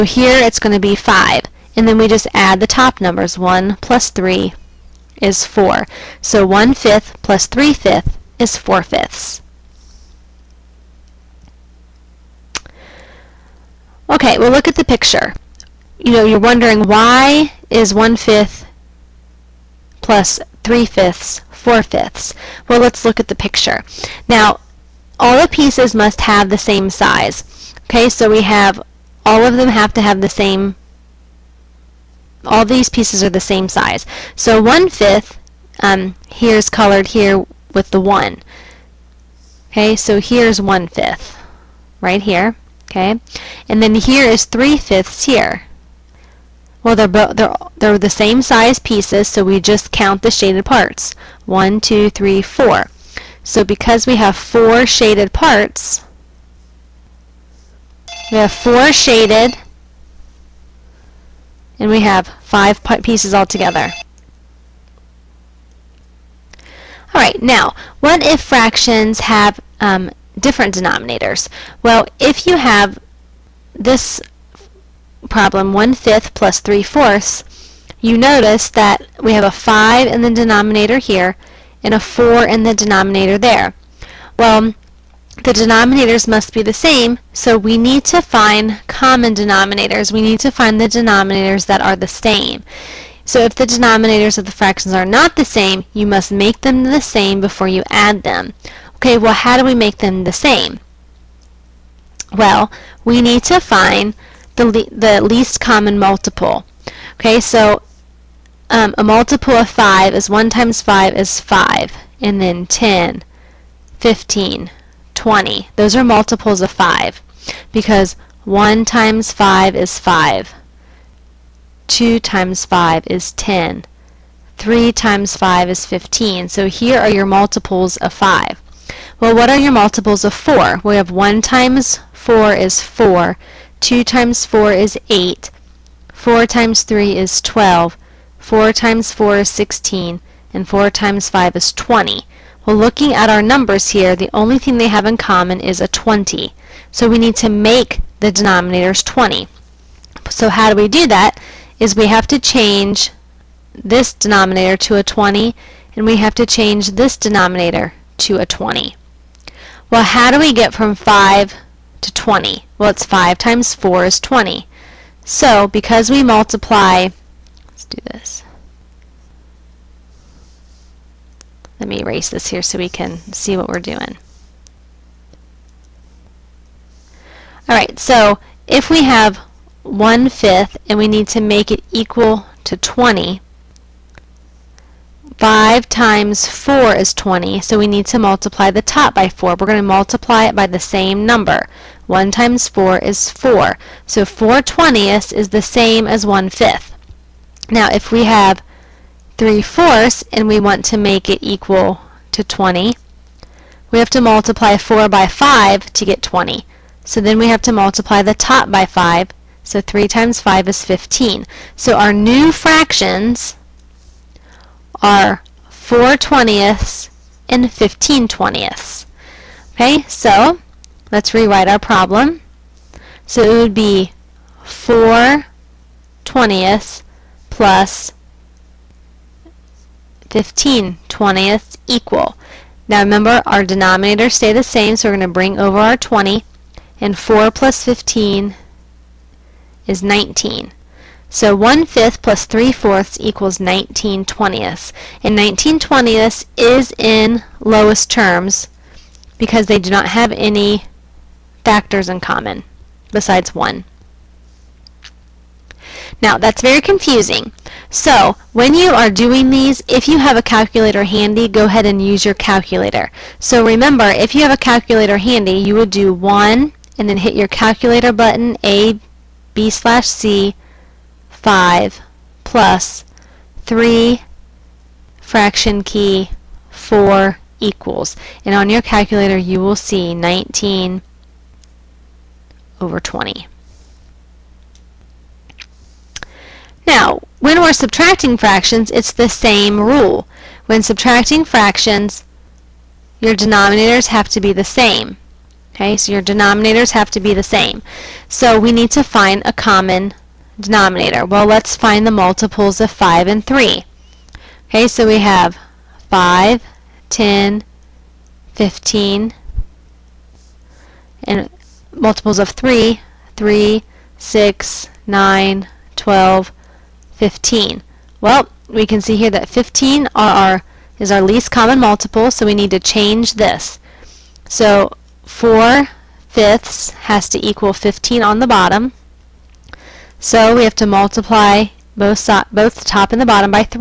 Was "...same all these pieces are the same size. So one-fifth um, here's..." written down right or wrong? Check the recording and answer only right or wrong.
right.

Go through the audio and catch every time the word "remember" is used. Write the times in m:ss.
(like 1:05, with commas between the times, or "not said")
3:52, 4:23.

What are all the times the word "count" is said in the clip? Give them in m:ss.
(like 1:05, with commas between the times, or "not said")
0:49.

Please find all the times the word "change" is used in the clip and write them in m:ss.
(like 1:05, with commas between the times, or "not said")
2:32, 2:36, 5:22.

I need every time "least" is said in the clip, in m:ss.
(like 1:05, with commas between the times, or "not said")
1:45, 5:21.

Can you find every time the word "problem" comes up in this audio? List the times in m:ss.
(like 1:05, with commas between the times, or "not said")
1:15, 3:41.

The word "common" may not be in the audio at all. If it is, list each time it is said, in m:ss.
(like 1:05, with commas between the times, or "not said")
1:28, 1:45, 2:25, 4:12, 4:59, 5:21.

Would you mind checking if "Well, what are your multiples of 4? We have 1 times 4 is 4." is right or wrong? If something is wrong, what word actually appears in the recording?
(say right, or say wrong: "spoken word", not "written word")
right.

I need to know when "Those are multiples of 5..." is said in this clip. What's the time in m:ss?
1:55.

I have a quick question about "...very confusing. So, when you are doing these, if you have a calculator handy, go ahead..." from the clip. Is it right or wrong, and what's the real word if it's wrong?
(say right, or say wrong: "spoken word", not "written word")
right.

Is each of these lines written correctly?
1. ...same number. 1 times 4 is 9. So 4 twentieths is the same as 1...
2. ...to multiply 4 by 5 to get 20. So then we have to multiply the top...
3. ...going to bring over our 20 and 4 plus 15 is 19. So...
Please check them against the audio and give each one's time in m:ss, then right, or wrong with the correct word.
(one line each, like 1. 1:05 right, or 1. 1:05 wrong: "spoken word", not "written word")
1. 3:10 wrong: "4", not "9"
2. 3:24 right
3. 3:55 right.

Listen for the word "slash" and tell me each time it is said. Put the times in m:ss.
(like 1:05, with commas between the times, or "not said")
4:29.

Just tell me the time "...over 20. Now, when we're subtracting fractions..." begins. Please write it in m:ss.
4:42.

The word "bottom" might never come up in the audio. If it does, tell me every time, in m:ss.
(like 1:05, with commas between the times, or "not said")
5:28, 5:33.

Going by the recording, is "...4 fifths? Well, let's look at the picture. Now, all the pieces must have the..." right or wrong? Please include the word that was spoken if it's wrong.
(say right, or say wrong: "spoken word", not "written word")
right.